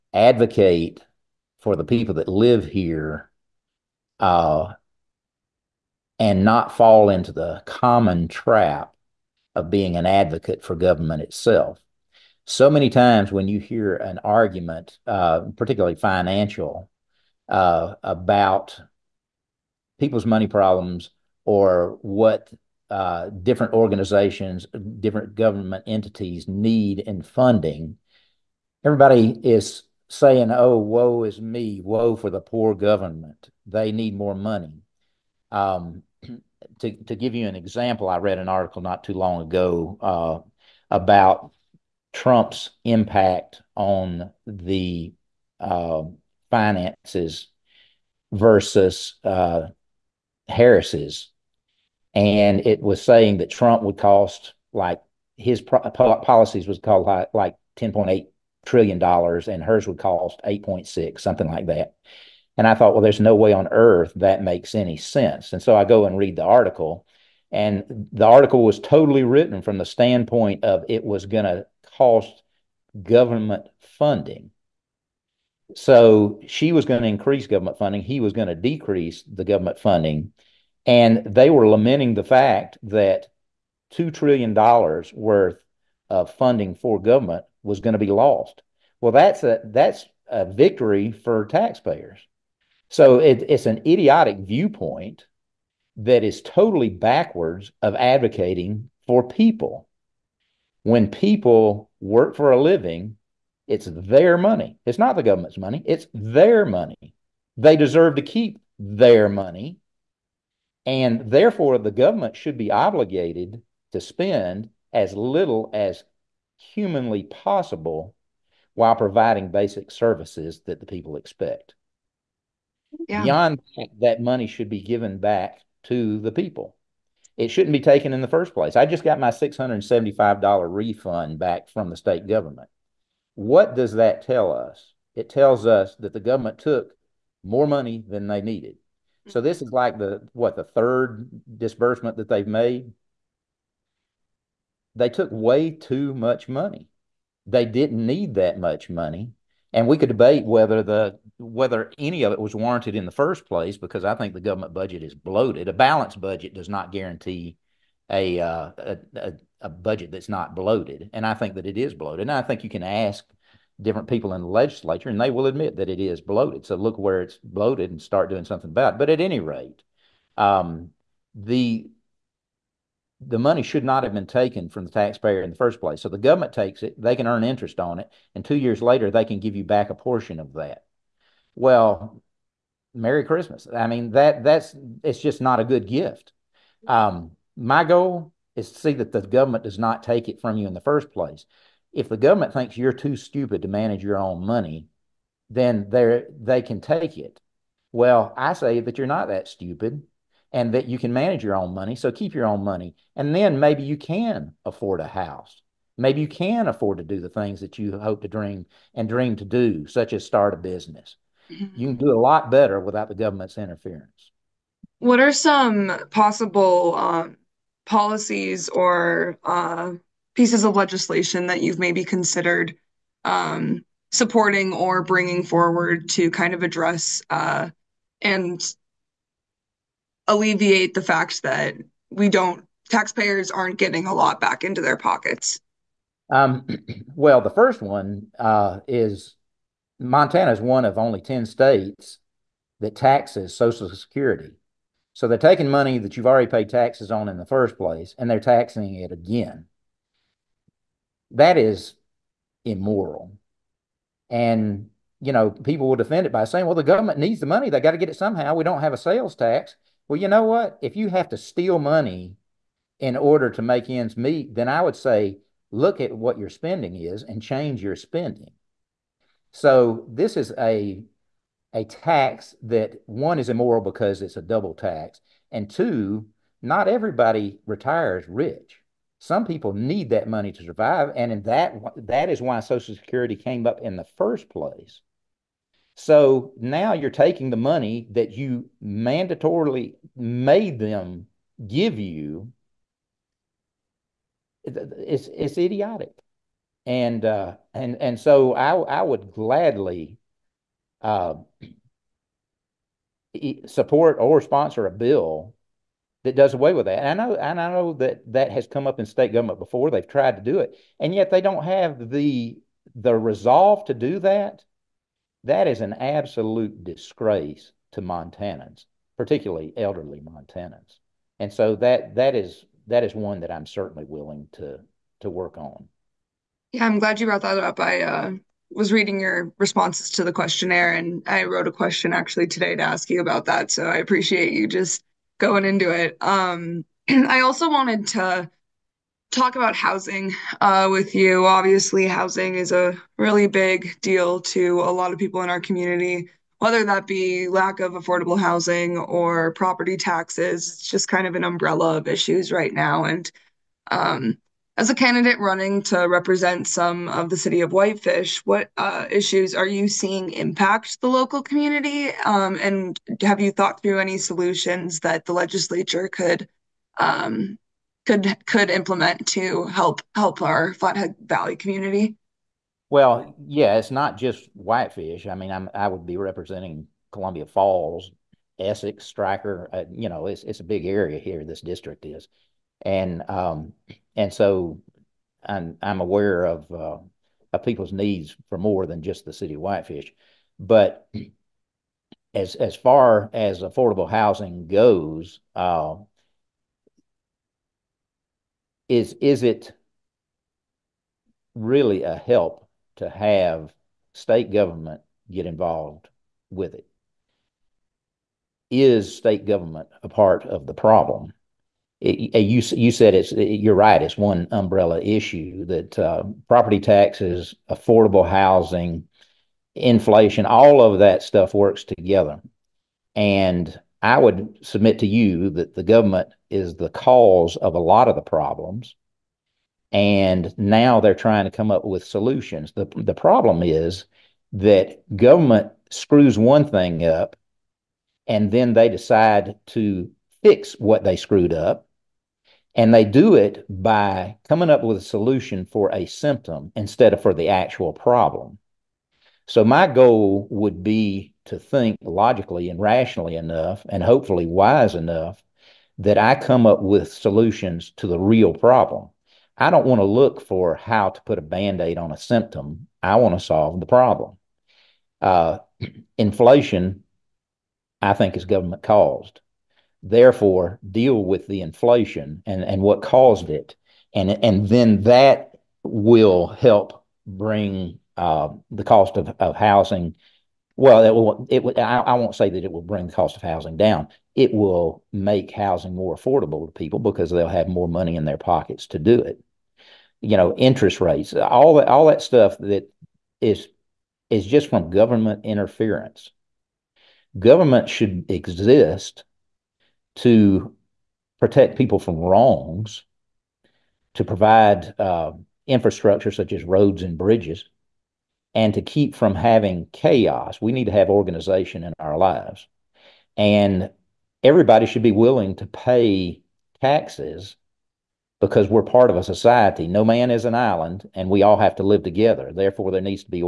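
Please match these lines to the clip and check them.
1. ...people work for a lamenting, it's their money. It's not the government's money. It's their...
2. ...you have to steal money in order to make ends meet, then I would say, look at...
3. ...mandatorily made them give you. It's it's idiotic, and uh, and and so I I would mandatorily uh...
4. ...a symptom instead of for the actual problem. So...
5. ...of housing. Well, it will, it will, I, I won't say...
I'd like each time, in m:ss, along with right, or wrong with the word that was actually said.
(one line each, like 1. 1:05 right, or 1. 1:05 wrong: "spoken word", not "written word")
1. 1:41 wrong: "living", not "lamenting"
2. 4:20 right
3. 4:48 wrong: "gladly", not "mandatorily"
4. 7:25 right
5. 7:59 right.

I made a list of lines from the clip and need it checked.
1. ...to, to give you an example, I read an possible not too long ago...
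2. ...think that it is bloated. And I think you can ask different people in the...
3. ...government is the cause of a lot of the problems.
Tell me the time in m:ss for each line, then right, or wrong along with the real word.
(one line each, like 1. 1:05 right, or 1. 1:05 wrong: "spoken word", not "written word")
1. 0:36 wrong: "article", not "possible"
2. 2:41 right
3. 7:05 right.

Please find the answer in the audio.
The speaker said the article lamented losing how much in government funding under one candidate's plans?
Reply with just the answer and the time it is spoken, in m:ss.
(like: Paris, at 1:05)
$2 trillion, at 1:23.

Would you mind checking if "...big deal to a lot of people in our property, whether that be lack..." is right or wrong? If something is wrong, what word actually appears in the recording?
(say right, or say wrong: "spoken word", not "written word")
wrong: "community", not "property".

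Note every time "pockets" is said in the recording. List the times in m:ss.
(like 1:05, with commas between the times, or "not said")
3:54, 8:08.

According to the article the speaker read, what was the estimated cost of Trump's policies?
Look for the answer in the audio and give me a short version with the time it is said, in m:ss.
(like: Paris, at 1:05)
$10.8 trillion, at 0:57.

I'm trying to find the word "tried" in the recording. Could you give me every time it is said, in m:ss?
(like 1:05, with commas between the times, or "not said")
5:10.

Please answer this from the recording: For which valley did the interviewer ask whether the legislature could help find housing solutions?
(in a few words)
Flathead Valley.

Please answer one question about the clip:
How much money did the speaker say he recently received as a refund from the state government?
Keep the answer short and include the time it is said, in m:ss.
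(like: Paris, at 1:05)
$675, at 2:09.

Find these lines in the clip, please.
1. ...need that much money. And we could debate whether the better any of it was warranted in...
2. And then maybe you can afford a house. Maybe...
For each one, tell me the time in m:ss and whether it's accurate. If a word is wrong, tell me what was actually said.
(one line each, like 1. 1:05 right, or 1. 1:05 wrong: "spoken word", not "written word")
1. 2:28 wrong: "whether", not "better"
2. 3:23 right.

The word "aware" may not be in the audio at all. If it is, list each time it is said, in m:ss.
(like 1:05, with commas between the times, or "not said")
6:26.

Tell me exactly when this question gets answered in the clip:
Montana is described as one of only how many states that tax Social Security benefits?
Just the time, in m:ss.
4:01.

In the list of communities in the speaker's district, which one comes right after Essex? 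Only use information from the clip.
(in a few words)
Stryker.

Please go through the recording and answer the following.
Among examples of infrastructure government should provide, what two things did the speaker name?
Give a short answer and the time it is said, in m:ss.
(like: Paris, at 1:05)
roads and bridges, at 8:26.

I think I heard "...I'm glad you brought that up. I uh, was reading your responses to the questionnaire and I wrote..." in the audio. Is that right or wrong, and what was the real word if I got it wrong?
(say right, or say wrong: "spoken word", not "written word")
right.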